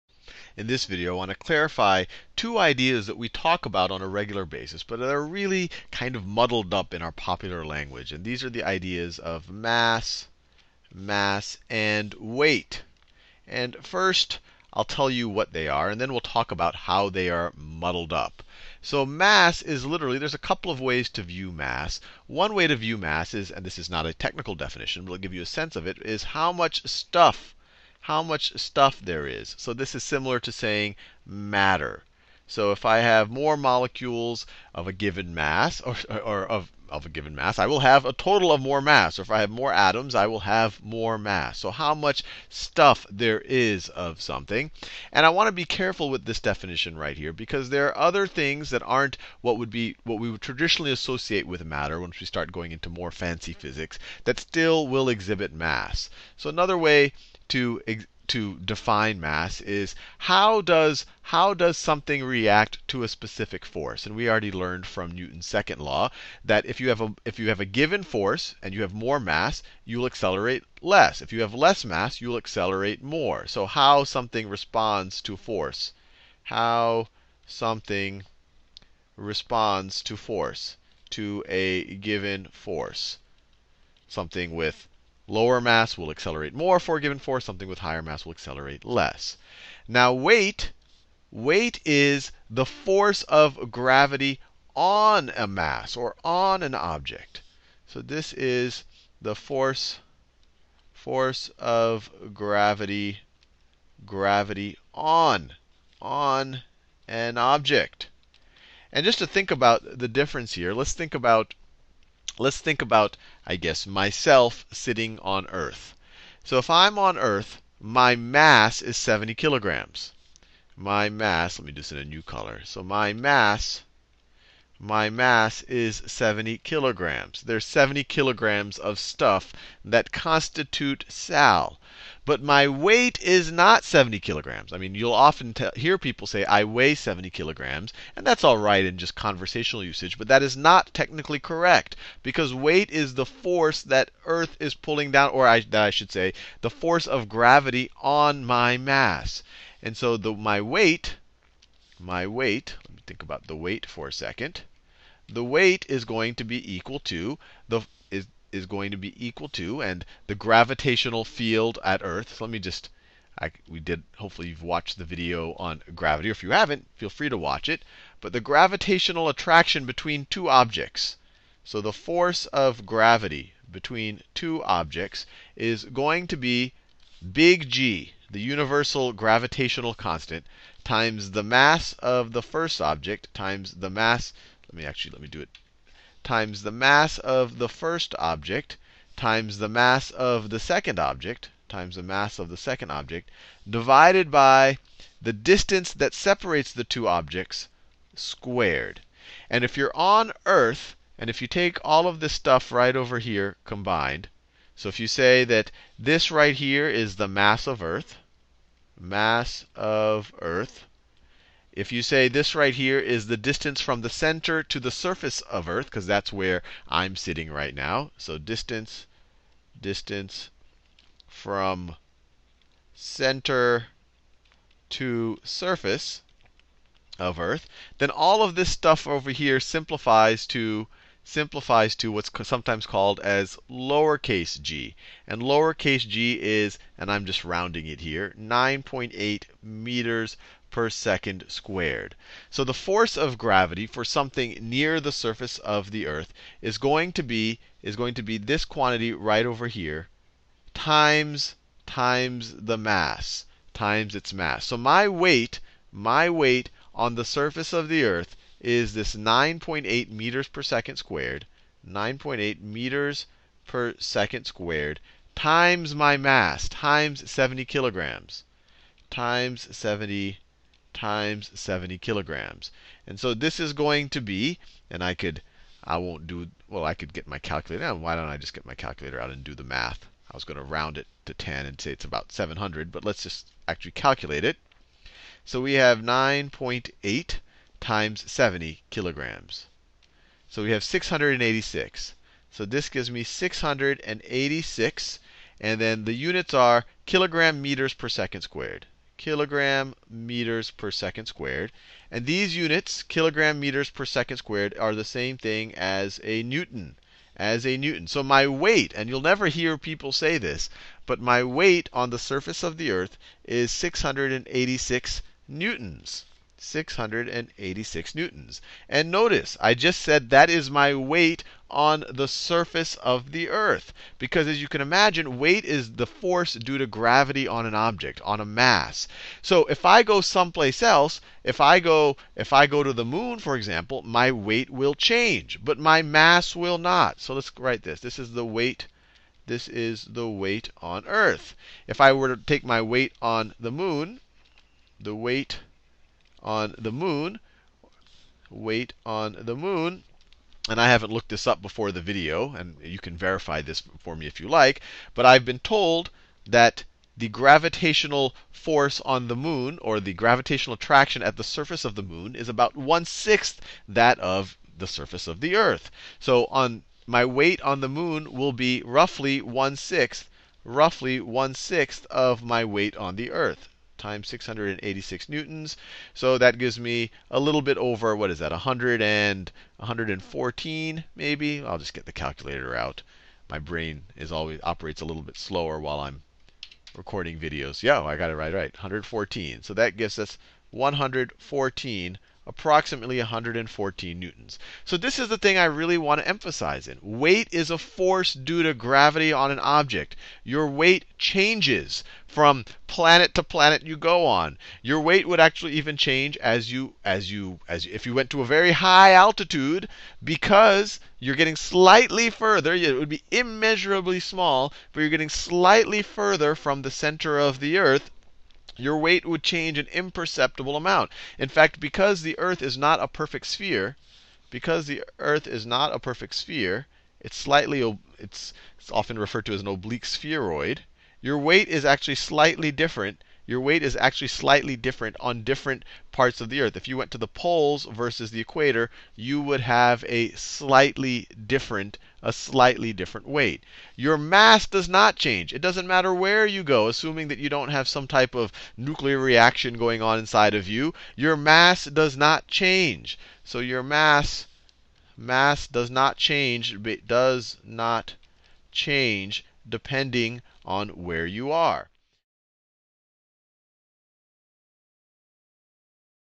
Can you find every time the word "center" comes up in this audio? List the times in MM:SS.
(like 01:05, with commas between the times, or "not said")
03:34, 03:42, 06:56.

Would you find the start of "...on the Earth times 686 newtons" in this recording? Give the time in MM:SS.
06:12.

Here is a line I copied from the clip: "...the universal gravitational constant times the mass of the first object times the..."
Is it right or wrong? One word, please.
right.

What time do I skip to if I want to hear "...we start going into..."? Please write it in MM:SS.
00:52.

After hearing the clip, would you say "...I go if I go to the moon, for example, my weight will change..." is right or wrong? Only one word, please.
right.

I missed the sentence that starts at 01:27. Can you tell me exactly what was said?
Something with higher mass will accelerate less.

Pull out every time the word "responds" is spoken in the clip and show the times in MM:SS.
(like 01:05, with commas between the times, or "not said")
01:14, 01:19.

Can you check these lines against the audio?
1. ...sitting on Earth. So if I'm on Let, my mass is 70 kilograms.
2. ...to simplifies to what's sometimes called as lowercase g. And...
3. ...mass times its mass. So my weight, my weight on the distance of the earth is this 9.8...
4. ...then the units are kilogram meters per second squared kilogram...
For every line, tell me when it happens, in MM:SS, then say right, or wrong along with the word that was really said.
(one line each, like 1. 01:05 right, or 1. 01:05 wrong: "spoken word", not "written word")
1. 01:54 wrong: "Earth", not "Let"
2. 03:50 right
3. 04:12 wrong: "surface", not "distance"
4. 04:55 right.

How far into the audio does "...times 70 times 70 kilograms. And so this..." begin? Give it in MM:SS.
04:29.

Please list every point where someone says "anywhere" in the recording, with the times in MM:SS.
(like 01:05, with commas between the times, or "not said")
not said.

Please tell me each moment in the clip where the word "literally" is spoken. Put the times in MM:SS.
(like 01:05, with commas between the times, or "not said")
00:19.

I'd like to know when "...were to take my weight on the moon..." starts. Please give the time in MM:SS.
05:42.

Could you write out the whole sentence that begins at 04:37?
Why don't I just get my calculator out and do the math?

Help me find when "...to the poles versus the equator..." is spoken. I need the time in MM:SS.
07:17.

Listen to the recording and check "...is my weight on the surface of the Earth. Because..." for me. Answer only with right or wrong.
right.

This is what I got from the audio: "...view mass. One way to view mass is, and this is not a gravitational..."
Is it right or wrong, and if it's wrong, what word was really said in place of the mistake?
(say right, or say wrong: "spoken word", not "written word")
wrong: "technical", not "gravitational".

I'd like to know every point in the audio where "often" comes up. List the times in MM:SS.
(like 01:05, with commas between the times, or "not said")
02:15, 07:08.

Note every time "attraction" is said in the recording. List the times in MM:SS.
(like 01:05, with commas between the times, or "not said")
02:49, 06:00.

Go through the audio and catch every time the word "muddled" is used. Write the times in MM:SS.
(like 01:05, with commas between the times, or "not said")
00:06, 00:17.